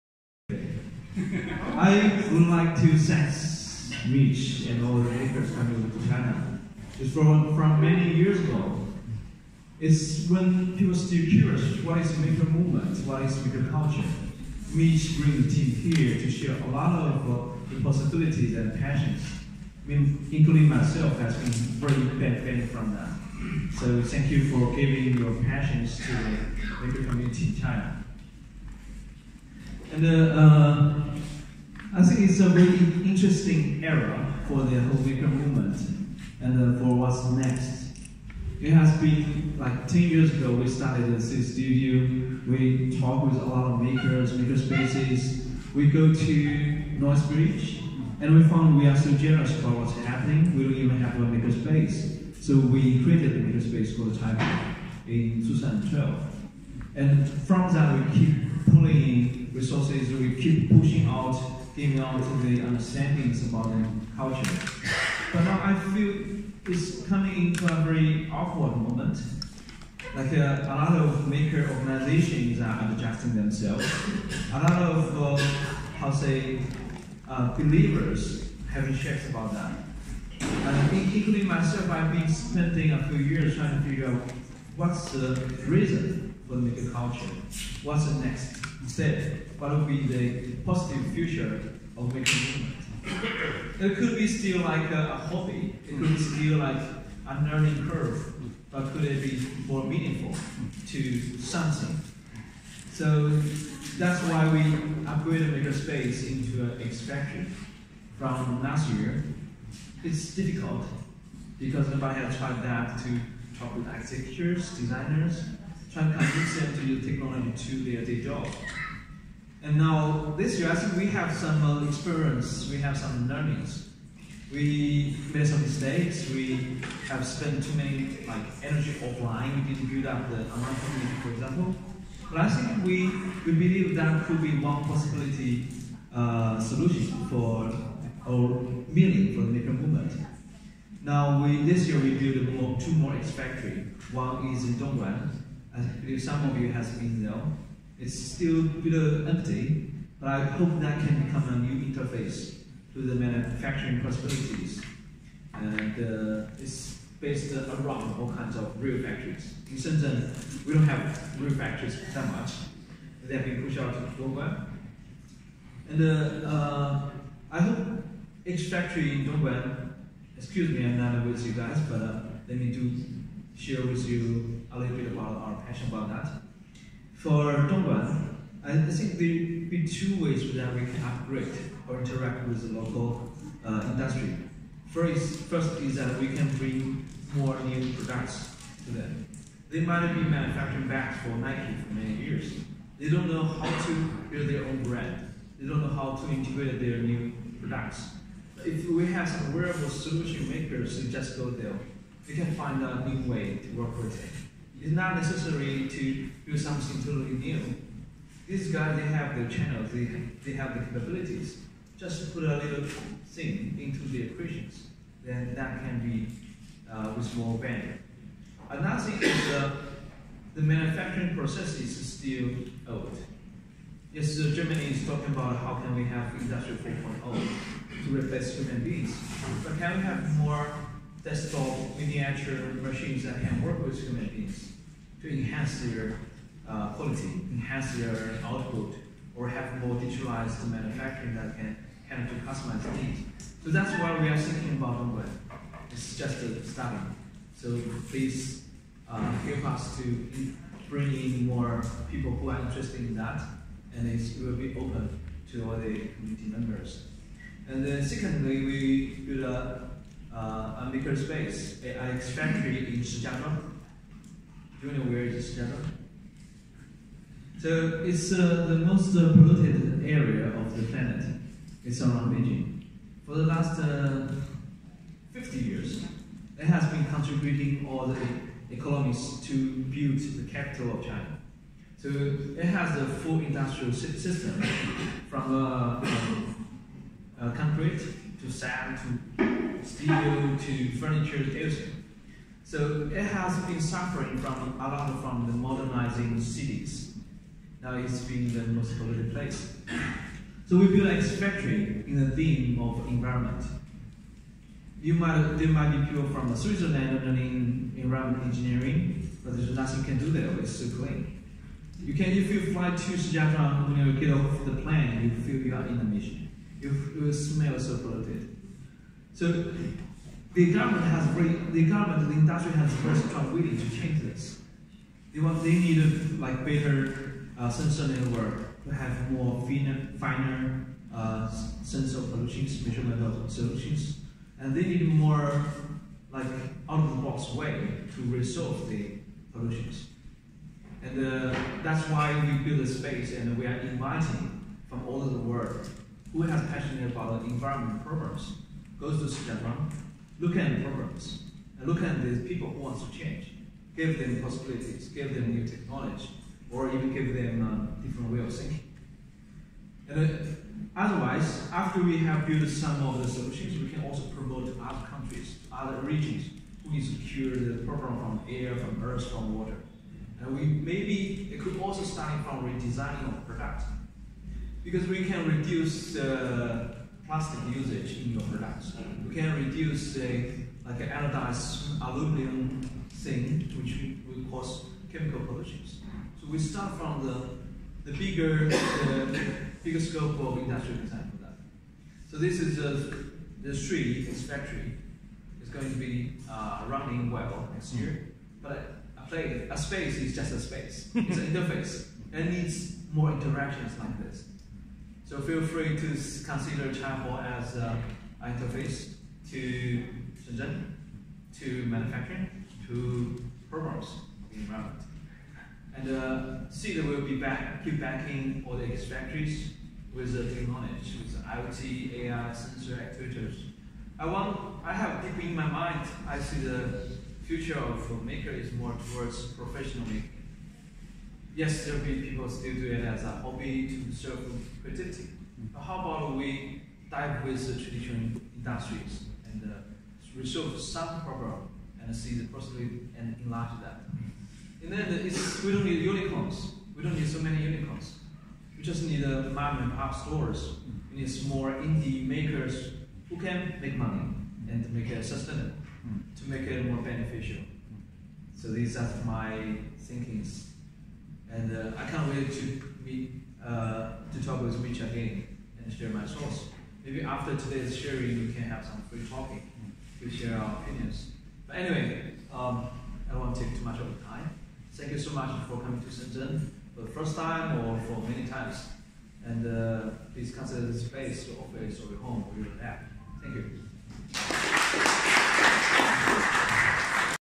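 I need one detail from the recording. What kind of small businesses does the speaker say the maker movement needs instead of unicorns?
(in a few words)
mom and pop stores.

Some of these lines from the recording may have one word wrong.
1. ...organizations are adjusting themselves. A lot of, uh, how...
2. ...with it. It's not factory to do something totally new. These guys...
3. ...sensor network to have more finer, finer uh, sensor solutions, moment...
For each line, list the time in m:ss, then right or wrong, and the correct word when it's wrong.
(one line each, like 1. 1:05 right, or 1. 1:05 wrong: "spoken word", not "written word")
1. 1:11 right
2. 3:23 wrong: "necessary", not "factory"
3. 5:27 wrong: "measurement", not "moment".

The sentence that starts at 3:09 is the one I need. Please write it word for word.
They might be manufacturing bags for Nike for many years.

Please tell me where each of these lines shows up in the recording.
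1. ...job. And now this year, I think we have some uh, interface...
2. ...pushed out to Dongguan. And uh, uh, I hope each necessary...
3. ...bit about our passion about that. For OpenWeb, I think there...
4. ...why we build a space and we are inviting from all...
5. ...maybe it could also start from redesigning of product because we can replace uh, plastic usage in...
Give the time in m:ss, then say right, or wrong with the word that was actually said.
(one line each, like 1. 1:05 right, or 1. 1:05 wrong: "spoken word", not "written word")
1. 1:58 wrong: "experience", not "interface"
2. 2:43 wrong: "factory", not "necessary"
3. 2:54 wrong: "Dongguan", not "OpenWeb"
4. 5:42 right
5. 6:10 wrong: "reduce", not "replace".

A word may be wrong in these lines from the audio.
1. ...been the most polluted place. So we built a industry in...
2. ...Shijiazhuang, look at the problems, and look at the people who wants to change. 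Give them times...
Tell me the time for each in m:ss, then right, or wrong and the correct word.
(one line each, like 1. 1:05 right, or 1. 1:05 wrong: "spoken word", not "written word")
1. 4:58 wrong: "factory", not "industry"
2. 5:49 wrong: "possibilities", not "times".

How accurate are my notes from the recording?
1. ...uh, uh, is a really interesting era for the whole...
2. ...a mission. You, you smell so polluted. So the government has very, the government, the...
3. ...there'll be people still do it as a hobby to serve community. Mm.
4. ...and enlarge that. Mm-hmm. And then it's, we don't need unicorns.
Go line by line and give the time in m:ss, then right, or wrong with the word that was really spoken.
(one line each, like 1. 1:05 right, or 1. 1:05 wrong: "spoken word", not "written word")
1. 0:30 right
2. 5:15 right
3. 7:11 wrong: "creativity", not "community"
4. 7:23 right.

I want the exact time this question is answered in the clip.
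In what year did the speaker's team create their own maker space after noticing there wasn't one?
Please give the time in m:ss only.
0:55.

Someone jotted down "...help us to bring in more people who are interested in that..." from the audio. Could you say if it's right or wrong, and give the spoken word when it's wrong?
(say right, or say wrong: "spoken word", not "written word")
right.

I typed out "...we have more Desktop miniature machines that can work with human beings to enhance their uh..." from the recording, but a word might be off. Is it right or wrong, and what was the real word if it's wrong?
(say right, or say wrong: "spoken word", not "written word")
right.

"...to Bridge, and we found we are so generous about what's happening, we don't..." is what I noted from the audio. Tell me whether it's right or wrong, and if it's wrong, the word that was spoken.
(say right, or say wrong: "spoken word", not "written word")
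right.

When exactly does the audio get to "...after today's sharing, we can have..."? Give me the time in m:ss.
7:47.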